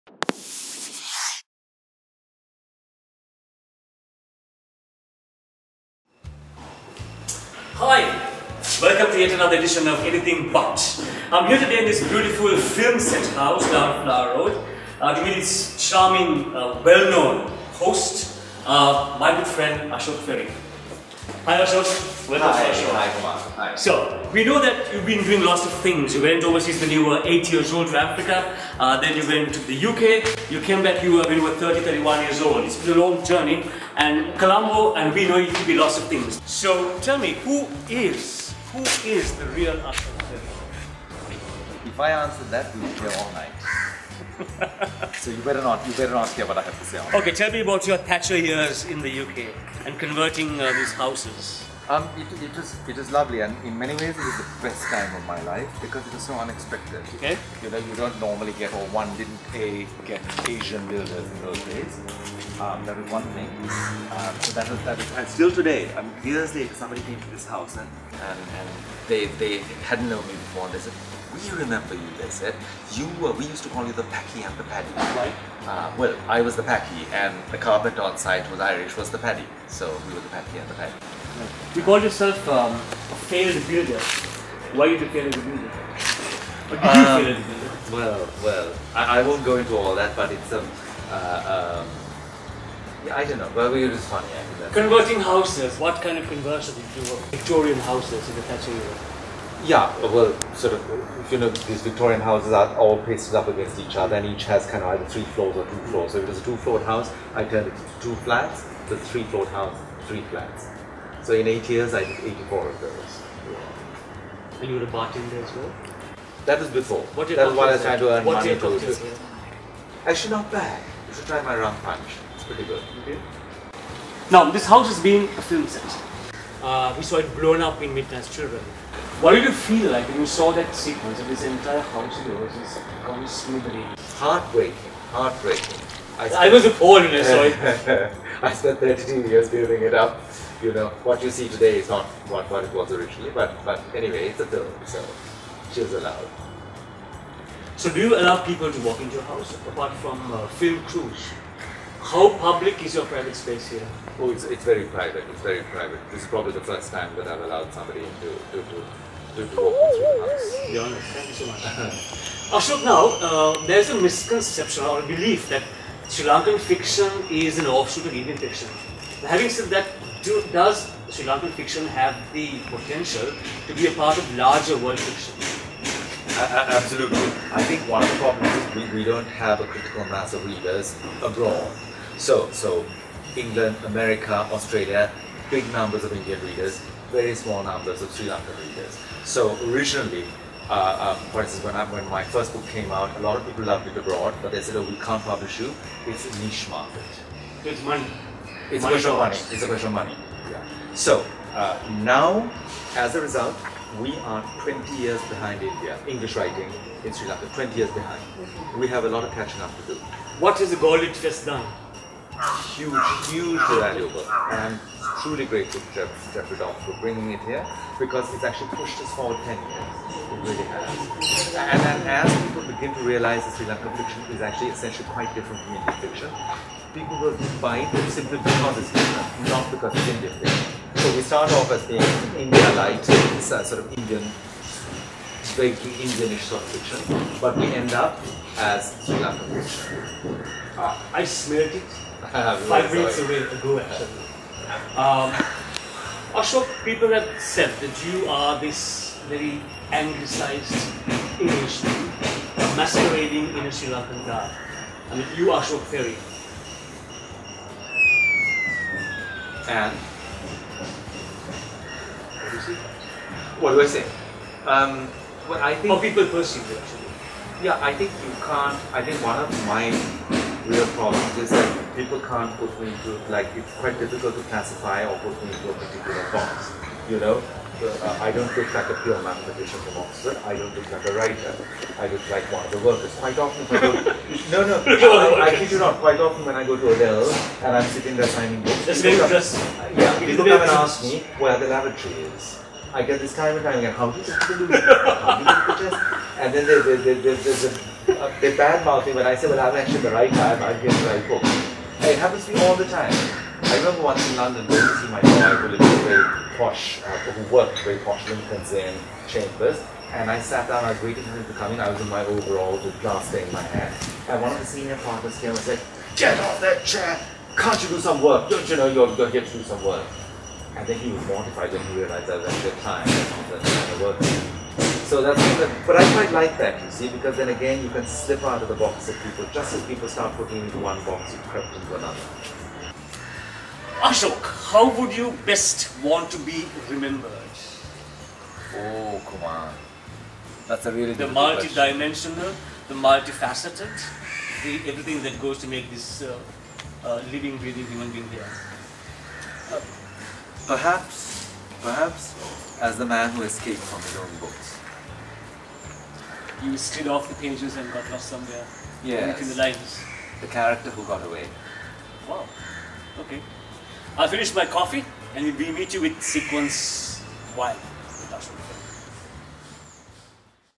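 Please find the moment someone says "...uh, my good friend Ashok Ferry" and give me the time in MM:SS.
00:18.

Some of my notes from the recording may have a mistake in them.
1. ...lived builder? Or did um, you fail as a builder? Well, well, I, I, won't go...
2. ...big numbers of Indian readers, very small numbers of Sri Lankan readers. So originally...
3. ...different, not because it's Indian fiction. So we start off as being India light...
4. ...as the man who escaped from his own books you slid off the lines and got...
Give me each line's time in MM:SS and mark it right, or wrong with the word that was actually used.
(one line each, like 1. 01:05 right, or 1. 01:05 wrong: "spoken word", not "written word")
1. 01:25 wrong: "failed", not "lived"
2. 03:05 right
3. 03:48 right
4. 05:52 wrong: "pages", not "lines".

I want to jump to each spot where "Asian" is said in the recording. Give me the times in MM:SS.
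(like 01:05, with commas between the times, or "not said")
01:00.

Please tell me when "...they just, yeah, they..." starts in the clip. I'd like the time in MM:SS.
04:49.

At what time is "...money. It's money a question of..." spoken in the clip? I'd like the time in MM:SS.
03:17.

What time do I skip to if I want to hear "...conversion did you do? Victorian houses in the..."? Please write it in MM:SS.
01:36.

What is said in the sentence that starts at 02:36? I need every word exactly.
This is probably the first time that I've allowed somebody to, to, to, to walk into the house.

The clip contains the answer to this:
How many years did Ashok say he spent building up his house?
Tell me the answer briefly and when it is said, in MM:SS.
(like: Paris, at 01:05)
32, at 02:18.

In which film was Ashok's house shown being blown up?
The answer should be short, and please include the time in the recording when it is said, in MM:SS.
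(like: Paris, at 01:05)
Midnight's Children, at 02:07.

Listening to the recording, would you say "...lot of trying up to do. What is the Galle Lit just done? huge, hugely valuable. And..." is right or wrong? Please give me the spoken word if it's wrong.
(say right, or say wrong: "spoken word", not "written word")
wrong: "catching", not "trying".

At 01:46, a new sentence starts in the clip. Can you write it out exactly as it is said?
So if it was a two-floored house, I turned it into two flats.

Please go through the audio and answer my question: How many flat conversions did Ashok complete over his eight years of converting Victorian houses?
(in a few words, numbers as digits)
84.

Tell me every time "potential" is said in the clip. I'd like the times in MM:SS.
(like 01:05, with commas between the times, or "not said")
02:52.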